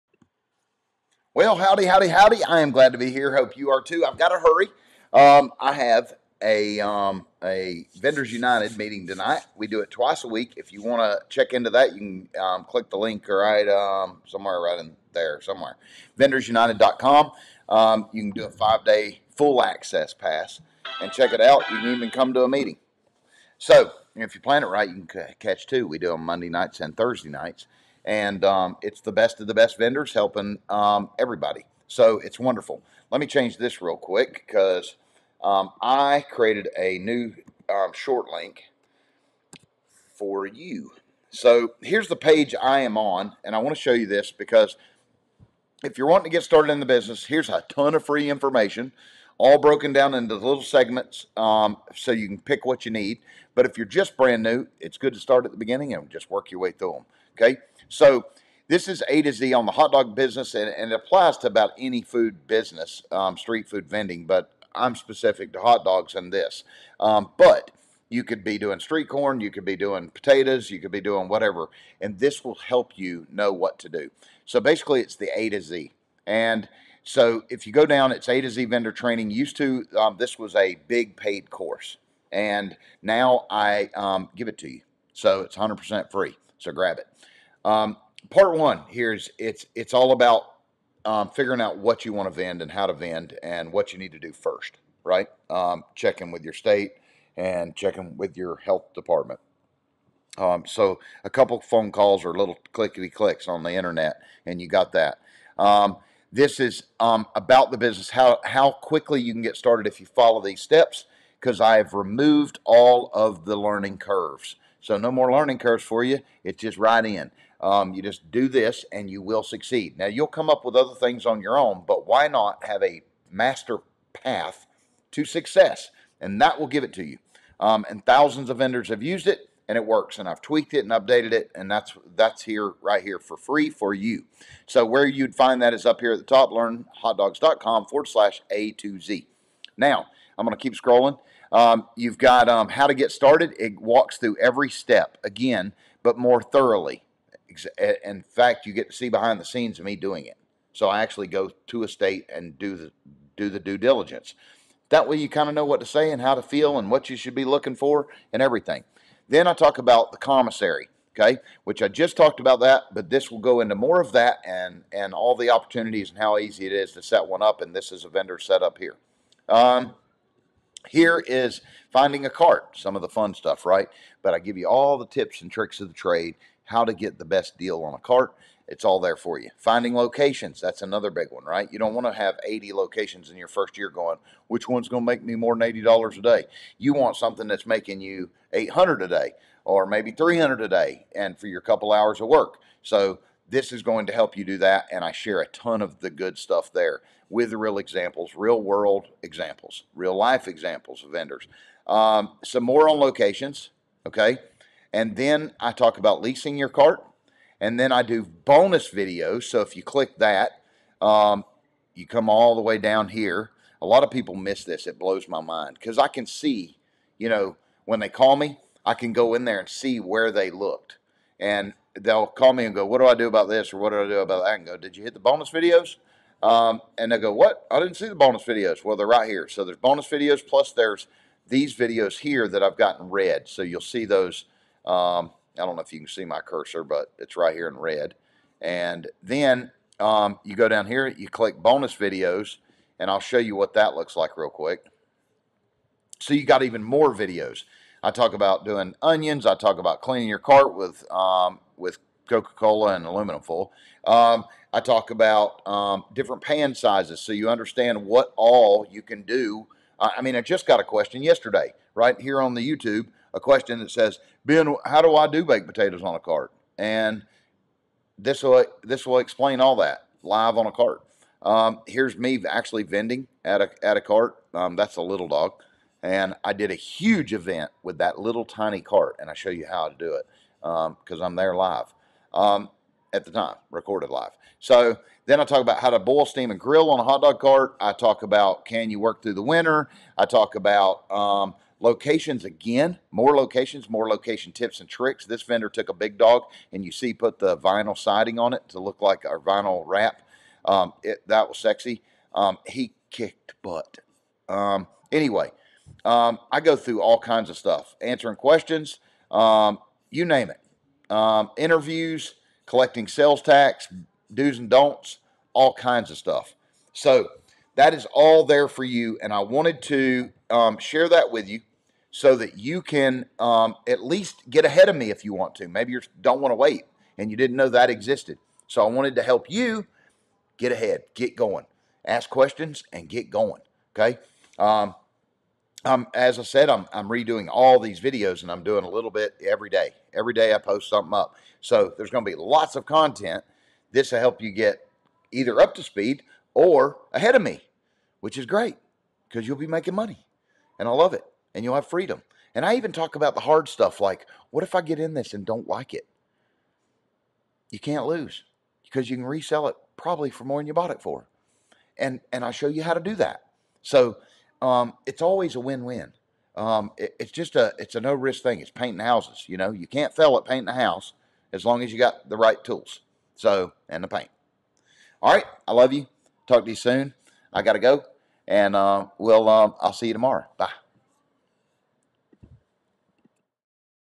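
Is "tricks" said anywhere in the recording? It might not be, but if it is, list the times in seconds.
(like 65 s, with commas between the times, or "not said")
175 s, 294 s.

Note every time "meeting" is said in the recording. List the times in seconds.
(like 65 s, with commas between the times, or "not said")
8 s, 22 s.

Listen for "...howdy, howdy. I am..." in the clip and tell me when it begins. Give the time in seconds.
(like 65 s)
1 s.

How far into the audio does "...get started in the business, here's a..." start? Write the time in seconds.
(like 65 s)
46 s.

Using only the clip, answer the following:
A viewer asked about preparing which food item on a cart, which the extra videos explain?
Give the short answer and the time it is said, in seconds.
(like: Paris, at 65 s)
Baked potatoes, at 265 s.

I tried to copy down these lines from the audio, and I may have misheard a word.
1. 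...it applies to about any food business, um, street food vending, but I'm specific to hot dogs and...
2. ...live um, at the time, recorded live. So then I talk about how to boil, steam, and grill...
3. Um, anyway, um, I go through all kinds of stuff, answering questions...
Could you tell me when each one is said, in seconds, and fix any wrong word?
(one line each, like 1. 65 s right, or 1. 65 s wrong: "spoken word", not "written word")
1. 60 s right
2. 281 s right
3. 304 s right.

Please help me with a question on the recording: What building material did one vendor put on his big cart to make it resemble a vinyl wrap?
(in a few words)
Vinyl siding.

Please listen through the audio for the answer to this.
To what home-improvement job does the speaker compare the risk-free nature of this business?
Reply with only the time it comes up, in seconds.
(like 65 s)
368 s.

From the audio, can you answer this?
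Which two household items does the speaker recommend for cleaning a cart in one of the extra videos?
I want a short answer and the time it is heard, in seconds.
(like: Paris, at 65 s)
Coca-Cola and aluminum foil, at 252 s.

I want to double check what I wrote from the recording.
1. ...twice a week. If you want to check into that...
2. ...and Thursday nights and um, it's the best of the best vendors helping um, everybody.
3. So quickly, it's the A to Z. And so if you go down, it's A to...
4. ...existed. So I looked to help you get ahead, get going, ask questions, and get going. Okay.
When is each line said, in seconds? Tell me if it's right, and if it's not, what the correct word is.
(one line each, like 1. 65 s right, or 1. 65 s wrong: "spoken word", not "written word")
1. 9 s right
2. 26 s right
3. 74 s wrong: "basically", not "quickly"
4. 327 s wrong: "wanted", not "looked".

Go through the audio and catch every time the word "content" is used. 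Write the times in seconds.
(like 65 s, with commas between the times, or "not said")
342 s.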